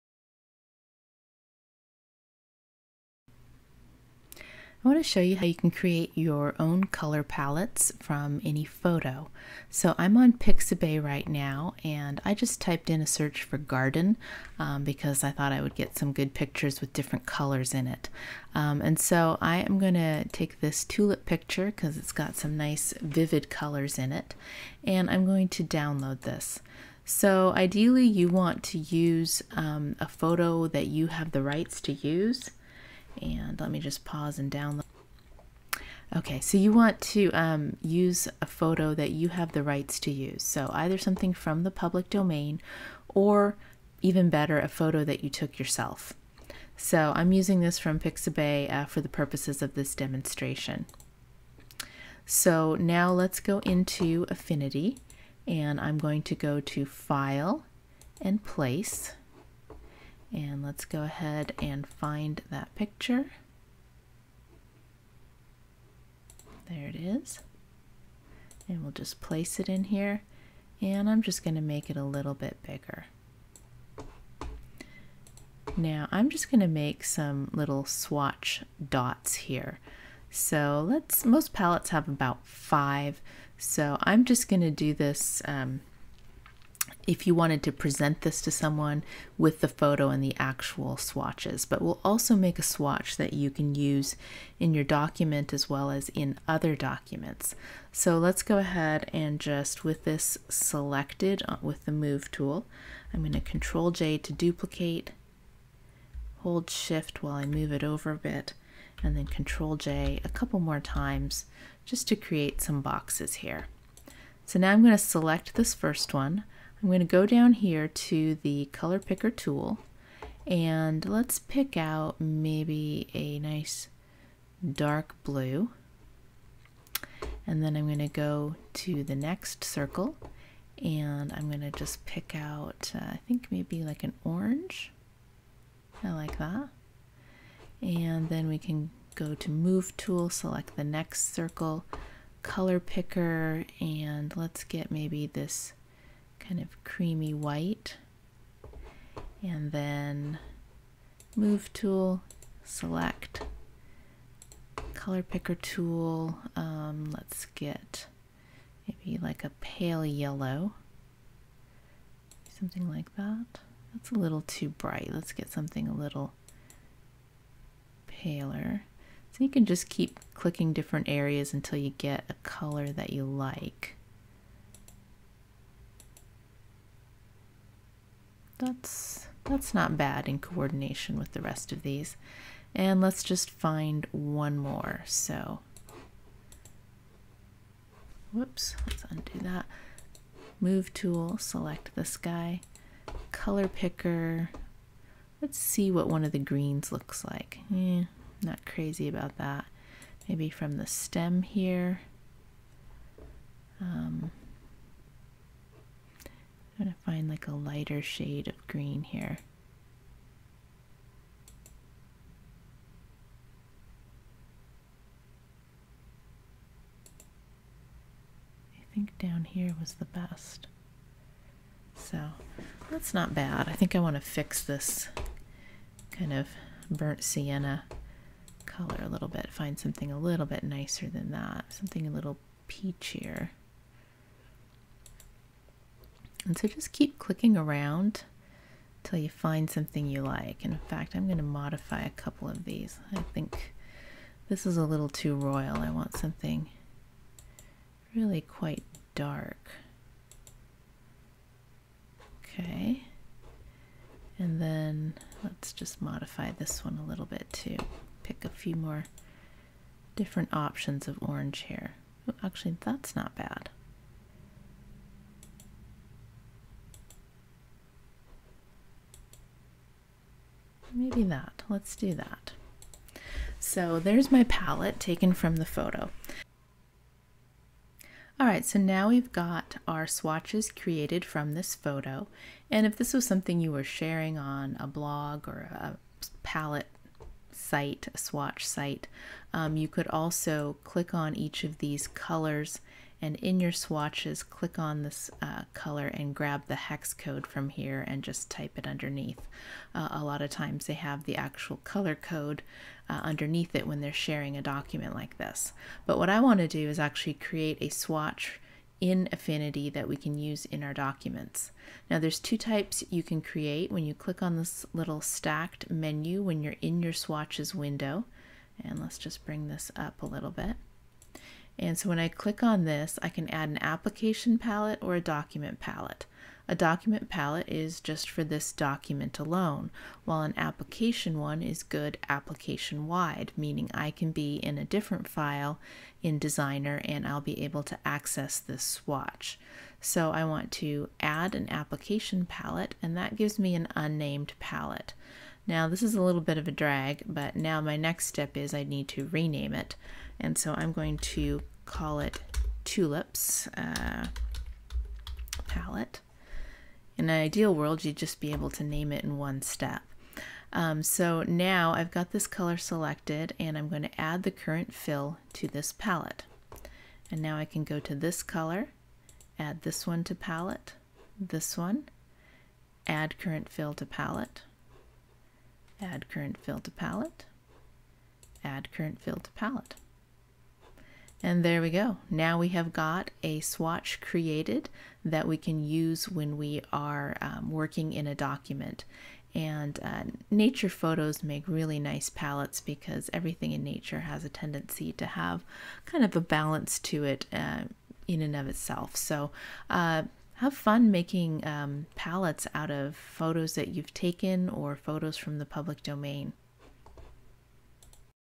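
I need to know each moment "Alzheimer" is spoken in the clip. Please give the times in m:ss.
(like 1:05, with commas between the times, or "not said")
not said.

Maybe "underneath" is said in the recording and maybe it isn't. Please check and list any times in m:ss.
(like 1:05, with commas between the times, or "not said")
4:58, 5:03.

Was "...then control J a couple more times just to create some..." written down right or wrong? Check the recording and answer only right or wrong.
right.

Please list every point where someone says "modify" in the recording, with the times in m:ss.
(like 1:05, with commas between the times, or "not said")
4:01, 4:16.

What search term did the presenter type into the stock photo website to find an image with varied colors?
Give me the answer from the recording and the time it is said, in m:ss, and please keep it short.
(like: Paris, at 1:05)
garden, at 0:13.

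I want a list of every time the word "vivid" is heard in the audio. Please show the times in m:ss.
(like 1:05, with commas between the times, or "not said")
0:23.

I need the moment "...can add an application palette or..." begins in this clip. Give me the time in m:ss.
5:23.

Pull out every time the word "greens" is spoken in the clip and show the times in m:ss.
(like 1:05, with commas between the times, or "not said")
3:16, 3:28.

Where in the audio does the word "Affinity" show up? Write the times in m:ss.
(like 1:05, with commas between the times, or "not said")
0:54, 5:09.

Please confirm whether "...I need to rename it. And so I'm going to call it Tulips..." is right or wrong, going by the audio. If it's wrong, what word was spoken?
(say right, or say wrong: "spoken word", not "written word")
right.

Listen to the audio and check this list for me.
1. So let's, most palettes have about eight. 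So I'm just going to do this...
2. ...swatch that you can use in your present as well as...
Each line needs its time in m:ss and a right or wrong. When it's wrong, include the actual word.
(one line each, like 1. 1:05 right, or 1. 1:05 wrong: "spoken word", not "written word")
1. 1:20 wrong: "five", not "eight"
2. 1:32 wrong: "document", not "present".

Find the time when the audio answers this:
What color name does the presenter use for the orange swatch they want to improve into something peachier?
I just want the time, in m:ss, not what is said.
3:46.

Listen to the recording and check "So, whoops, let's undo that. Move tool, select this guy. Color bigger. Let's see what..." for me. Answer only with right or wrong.
wrong.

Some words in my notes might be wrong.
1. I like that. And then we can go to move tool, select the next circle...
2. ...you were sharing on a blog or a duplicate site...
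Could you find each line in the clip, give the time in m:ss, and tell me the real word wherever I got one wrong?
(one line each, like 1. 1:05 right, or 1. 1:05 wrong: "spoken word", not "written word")
1. 2:16 right
2. 4:43 wrong: "palette", not "duplicate".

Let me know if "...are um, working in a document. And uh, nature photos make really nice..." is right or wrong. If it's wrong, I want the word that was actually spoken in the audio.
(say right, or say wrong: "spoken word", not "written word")
right.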